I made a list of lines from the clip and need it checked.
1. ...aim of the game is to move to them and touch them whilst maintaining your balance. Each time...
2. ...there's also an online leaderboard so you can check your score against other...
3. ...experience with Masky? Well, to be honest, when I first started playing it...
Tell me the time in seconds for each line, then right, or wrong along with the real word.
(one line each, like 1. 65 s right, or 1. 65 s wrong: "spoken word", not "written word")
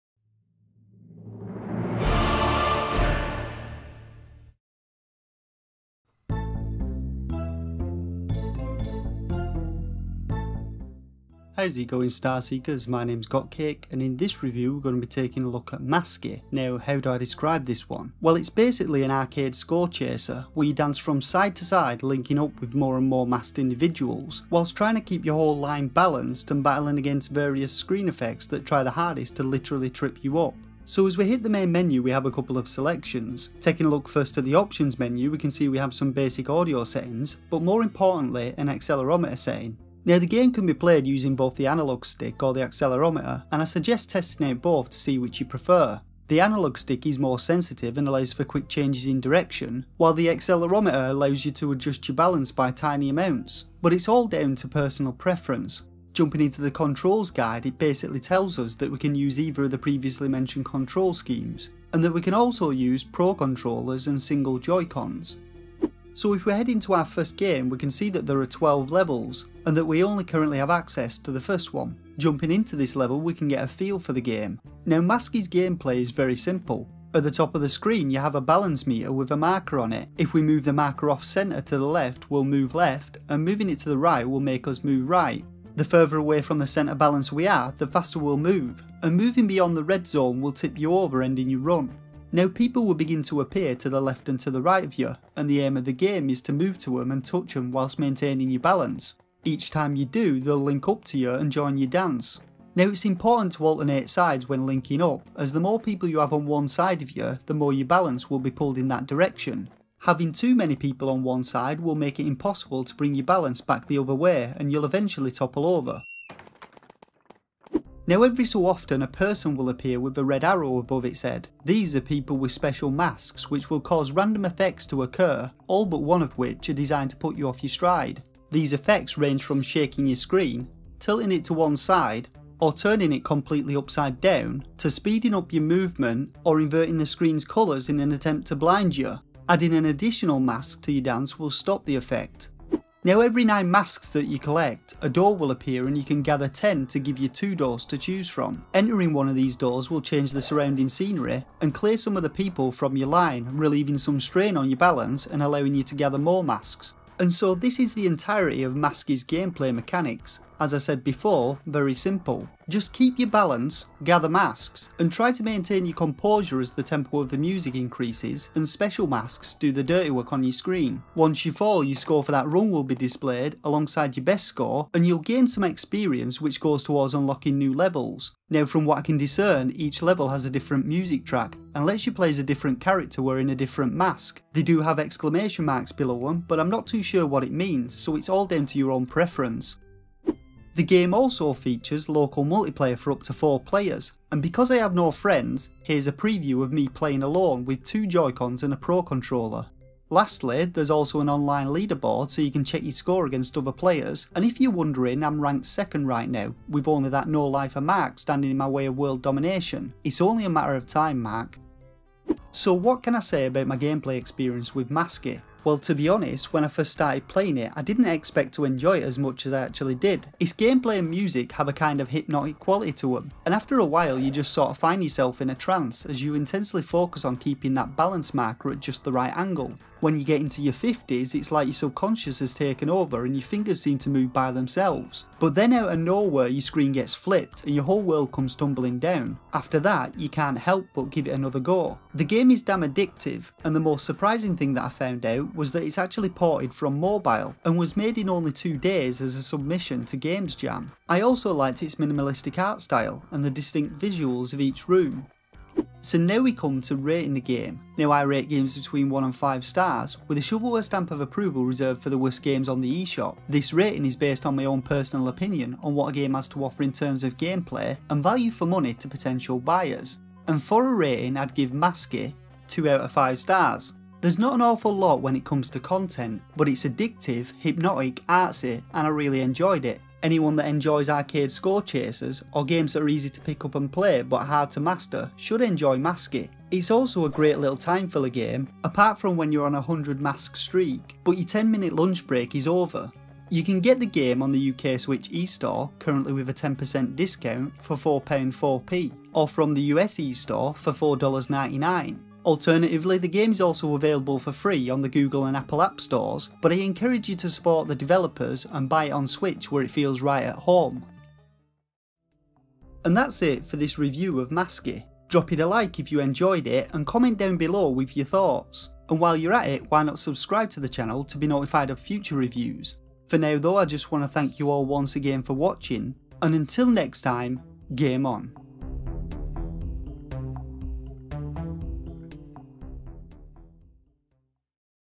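1. 95 s right
2. 200 s right
3. 214 s right.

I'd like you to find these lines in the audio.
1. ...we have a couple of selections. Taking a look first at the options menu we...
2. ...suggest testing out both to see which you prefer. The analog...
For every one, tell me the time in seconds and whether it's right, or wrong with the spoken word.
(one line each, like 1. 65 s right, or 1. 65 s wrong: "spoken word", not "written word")
1. 32 s right
2. 43 s right.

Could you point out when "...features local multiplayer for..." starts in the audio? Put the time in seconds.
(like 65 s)
191 s.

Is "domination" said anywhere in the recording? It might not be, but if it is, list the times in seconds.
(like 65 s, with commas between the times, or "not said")
209 s.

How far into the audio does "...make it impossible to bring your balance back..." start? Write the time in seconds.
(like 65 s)
111 s.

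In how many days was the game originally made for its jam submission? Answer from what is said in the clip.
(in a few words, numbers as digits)
2.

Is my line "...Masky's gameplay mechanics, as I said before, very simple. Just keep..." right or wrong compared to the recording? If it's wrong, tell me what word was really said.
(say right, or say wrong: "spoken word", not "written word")
right.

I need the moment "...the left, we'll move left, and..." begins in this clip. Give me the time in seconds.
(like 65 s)
81 s.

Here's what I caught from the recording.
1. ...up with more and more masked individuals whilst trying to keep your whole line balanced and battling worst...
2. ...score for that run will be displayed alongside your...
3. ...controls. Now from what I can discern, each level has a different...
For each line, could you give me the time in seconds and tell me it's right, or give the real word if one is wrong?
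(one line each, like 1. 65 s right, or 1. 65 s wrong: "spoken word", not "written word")
1. 22 s wrong: "against", not "worst"
2. 171 s right
3. 177 s wrong: "levels", not "controls".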